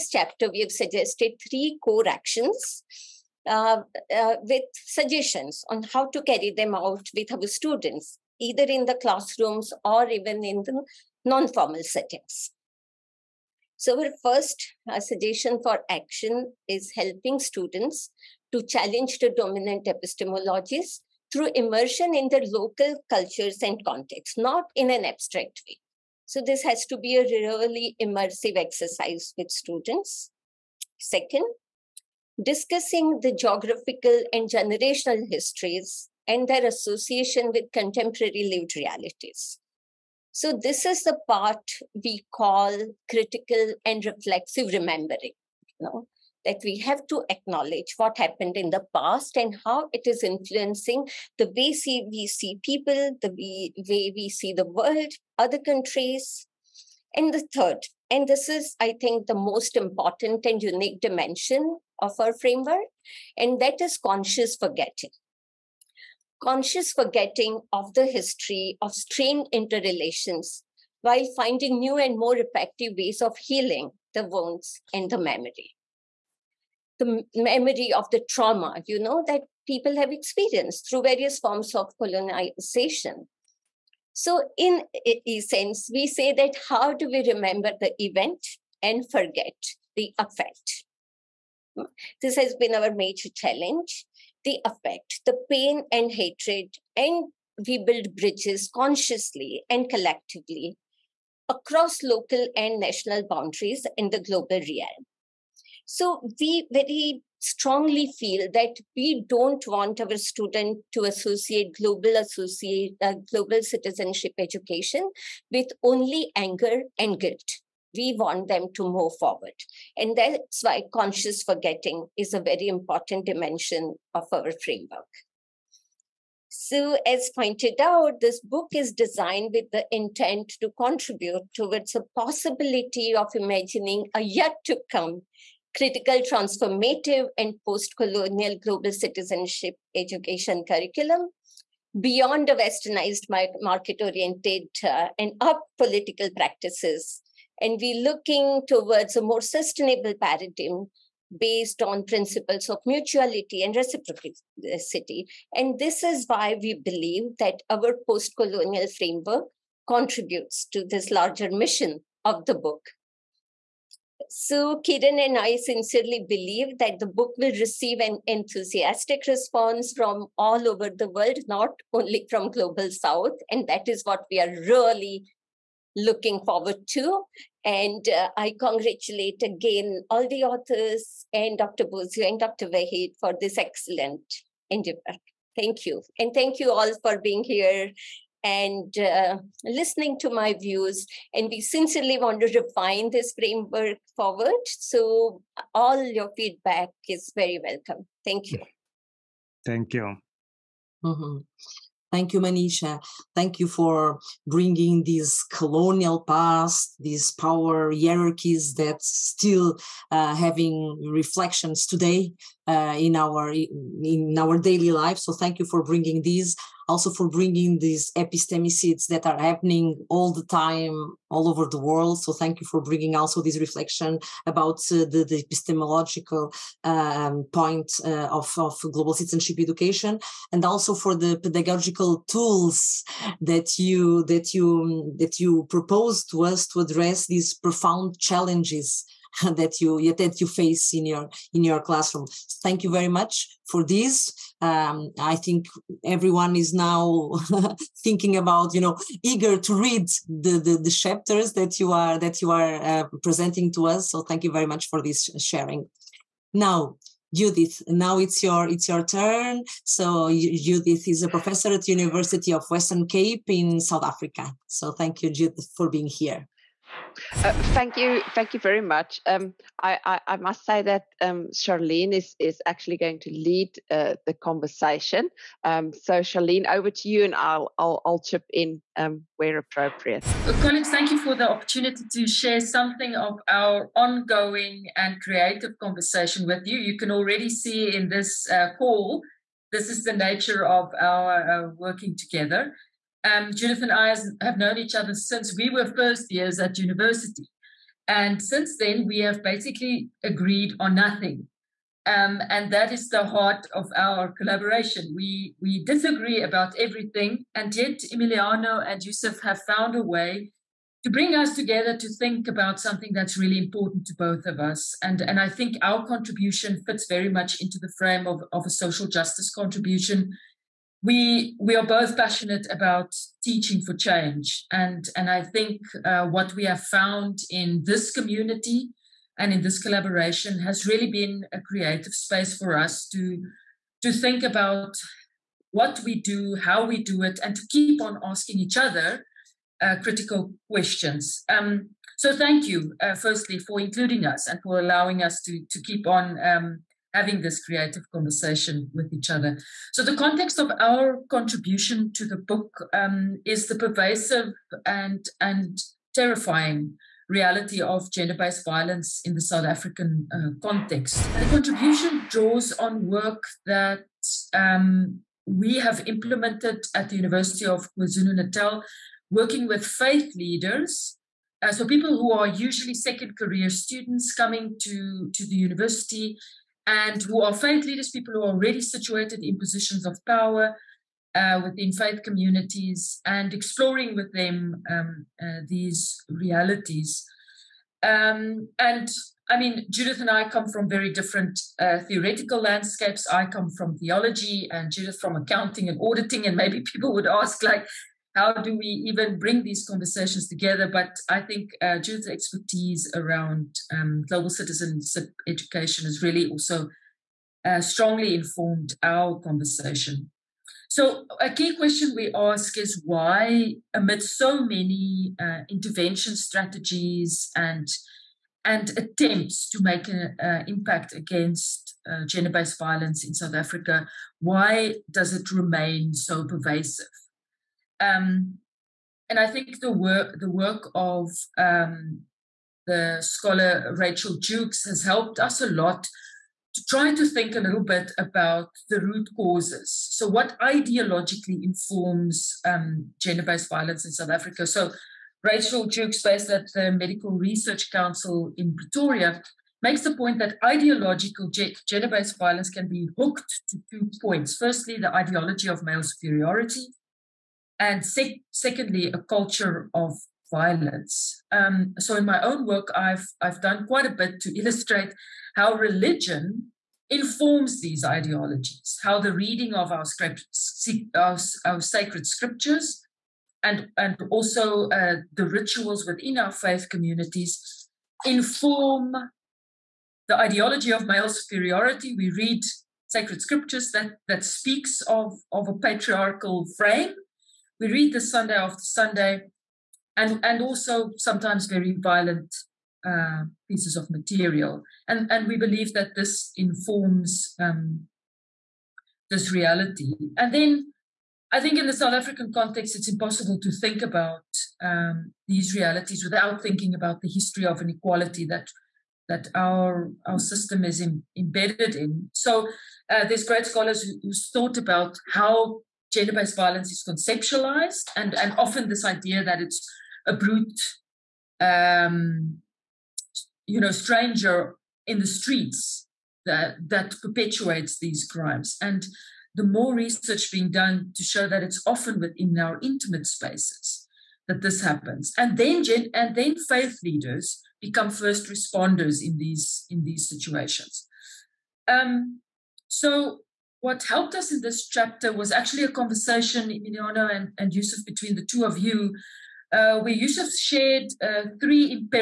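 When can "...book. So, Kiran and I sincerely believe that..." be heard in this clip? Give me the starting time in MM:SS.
02:42.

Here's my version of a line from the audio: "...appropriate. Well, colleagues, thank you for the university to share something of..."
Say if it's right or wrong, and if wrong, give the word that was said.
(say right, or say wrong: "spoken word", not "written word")
wrong: "opportunity", not "university".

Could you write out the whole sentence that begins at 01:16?
The memory of the trauma, you know, that people have experienced through various forms of colonization.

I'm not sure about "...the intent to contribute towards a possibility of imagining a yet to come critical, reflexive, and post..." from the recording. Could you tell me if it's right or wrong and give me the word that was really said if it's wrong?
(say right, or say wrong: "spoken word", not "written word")
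wrong: "transformative", not "reflexive".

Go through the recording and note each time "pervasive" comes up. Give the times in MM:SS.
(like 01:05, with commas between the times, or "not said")
05:53, 07:06.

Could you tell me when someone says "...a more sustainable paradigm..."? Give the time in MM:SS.
02:29.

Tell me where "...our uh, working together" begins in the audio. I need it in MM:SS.
04:51.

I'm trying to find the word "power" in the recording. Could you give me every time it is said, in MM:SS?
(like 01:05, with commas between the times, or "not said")
03:27, 06:20.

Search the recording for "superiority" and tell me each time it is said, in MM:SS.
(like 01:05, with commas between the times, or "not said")
07:36, 08:01.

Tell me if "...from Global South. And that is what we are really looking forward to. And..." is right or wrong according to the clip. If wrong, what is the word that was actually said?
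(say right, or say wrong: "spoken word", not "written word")
right.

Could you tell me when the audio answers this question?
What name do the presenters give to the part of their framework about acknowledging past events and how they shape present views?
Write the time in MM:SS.
00:43.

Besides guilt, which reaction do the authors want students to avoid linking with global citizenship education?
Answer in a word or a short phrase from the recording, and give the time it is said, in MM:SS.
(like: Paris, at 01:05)
Anger, at 01:56.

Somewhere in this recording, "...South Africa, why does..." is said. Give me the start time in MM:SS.
07:03.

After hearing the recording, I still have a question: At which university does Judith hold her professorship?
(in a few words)
University of Western Cape.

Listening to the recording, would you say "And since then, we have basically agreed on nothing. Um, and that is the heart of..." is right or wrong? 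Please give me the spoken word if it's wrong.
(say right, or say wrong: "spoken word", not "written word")
right.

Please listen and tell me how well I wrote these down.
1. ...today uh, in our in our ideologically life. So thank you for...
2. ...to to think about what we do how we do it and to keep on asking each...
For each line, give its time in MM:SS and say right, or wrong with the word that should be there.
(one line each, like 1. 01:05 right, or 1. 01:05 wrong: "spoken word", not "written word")
1. 03:31 wrong: "daily", not "ideologically"
2. 05:33 right.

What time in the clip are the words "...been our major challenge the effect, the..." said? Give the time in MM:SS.
01:32.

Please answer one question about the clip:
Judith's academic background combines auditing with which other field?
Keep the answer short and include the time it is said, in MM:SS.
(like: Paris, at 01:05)
Accounting, at 06:35.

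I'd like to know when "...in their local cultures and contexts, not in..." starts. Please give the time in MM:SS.
00:22.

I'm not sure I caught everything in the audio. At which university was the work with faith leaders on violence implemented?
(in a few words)
University of KwaZulu Natal.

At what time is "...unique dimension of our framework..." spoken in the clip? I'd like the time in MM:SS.
01:00.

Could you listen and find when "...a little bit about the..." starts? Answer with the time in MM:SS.
07:17.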